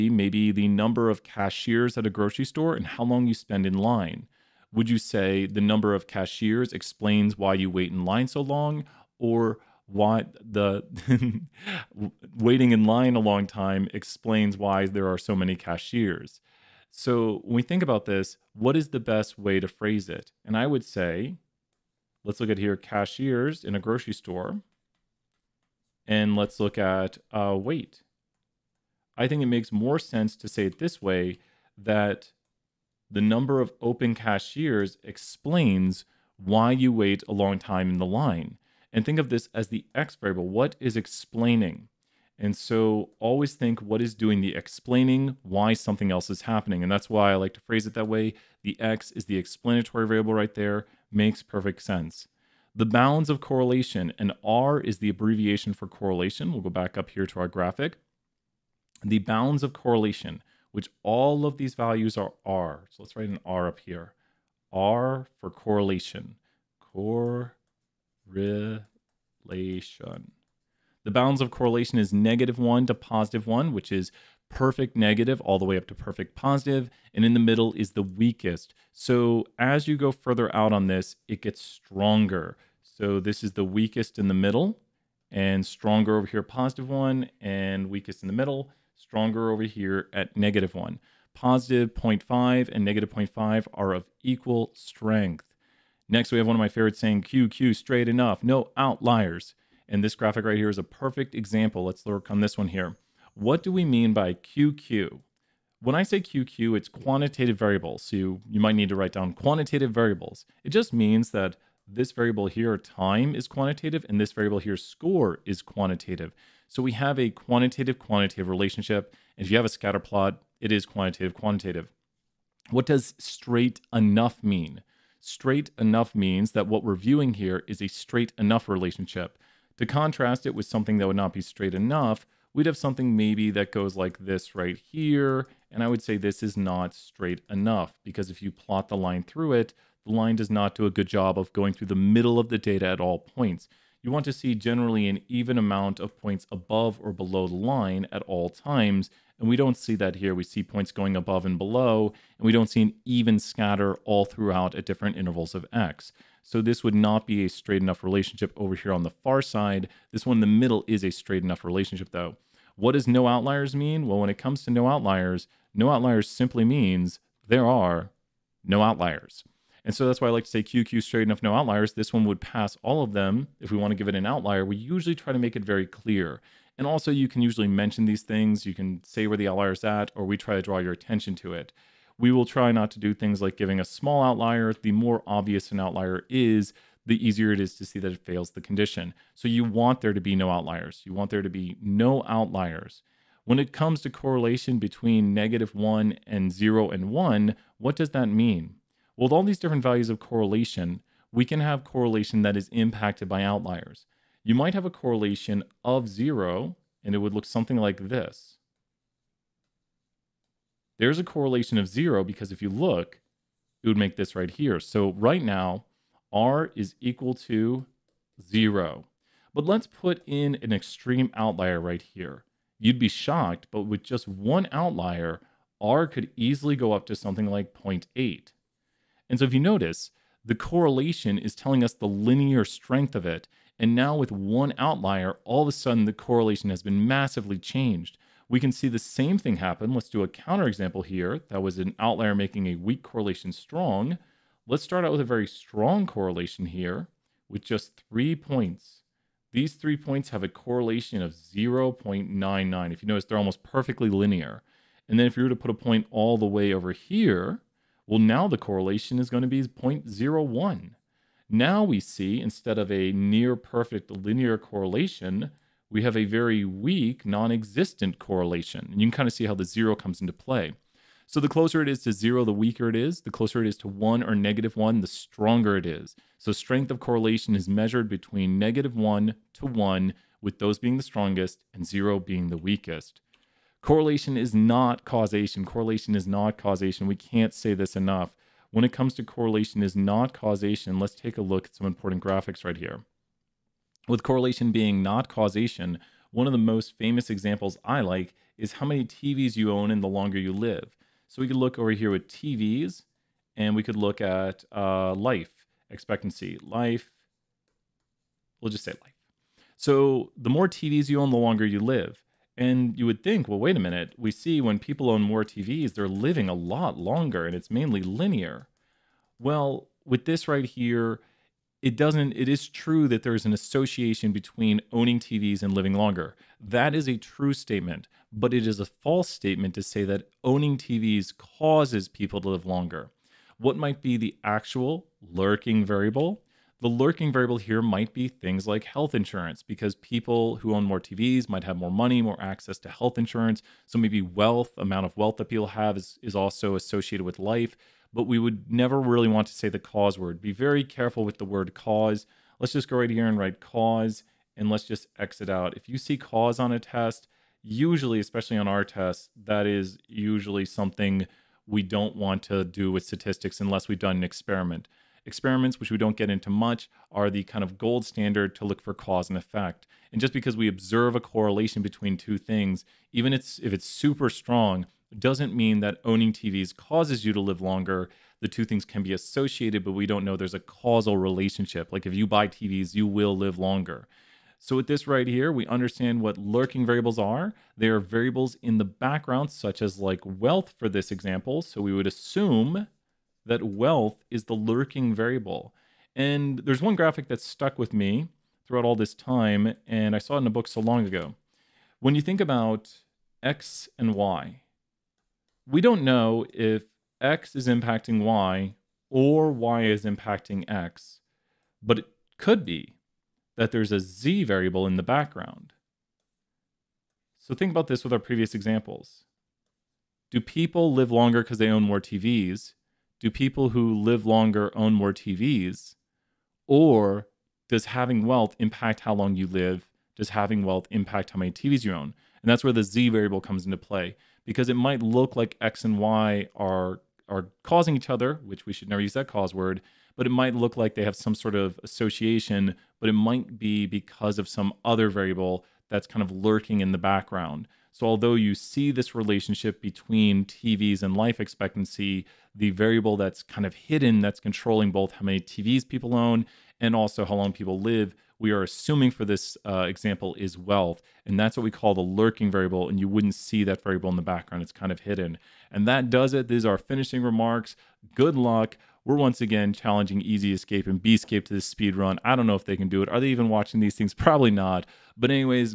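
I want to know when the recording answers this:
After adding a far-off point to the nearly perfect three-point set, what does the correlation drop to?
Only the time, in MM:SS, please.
04:19.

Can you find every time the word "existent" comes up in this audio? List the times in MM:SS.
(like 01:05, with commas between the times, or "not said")
04:27.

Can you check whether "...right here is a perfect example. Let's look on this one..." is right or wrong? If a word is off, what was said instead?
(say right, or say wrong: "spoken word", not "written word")
right.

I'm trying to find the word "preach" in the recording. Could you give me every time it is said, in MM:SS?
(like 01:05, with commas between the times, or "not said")
not said.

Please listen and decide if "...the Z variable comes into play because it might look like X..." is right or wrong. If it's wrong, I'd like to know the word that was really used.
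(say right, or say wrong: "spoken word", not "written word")
right.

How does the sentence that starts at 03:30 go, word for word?
There's a correlation of zero because if you look, it would make this right here.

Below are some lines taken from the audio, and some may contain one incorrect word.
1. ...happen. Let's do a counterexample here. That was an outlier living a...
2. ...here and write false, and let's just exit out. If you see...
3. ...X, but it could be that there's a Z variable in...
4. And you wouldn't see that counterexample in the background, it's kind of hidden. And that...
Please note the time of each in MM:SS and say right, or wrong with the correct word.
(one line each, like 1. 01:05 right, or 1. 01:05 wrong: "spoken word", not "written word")
1. 03:59 wrong: "making", not "living"
2. 05:53 wrong: "cause", not "false"
3. 06:50 right
4. 07:42 wrong: "variable", not "counterexample".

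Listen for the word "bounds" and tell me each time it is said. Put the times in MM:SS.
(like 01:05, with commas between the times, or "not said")
00:52, 00:59, 01:11.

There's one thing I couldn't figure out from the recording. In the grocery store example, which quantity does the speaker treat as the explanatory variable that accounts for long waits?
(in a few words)
number of open cashiers.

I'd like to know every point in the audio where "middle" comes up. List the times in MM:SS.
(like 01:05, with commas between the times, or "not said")
01:17, 01:24, 01:28, 02:21, 02:40.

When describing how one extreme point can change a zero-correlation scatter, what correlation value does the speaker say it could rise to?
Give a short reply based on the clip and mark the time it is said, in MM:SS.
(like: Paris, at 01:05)
0.8, at 03:47.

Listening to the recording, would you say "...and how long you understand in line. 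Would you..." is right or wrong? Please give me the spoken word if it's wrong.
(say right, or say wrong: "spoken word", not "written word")
wrong: "spend", not "understand".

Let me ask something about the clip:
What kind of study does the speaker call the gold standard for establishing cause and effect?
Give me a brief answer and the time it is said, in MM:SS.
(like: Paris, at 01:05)
Experiments, at 06:05.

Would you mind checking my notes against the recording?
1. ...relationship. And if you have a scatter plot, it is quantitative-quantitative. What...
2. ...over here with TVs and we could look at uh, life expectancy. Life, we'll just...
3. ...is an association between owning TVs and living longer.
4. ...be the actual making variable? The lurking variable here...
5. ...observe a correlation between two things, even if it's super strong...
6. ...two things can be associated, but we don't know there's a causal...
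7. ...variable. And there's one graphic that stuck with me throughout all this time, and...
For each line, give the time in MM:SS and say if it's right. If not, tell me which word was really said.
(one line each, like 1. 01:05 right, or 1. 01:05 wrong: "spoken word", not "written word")
1. 01:58 right
2. 05:01 right
3. 05:23 right
4. 05:34 wrong: "lurking", not "making"
5. 06:10 right
6. 06:18 right
7. 06:35 right.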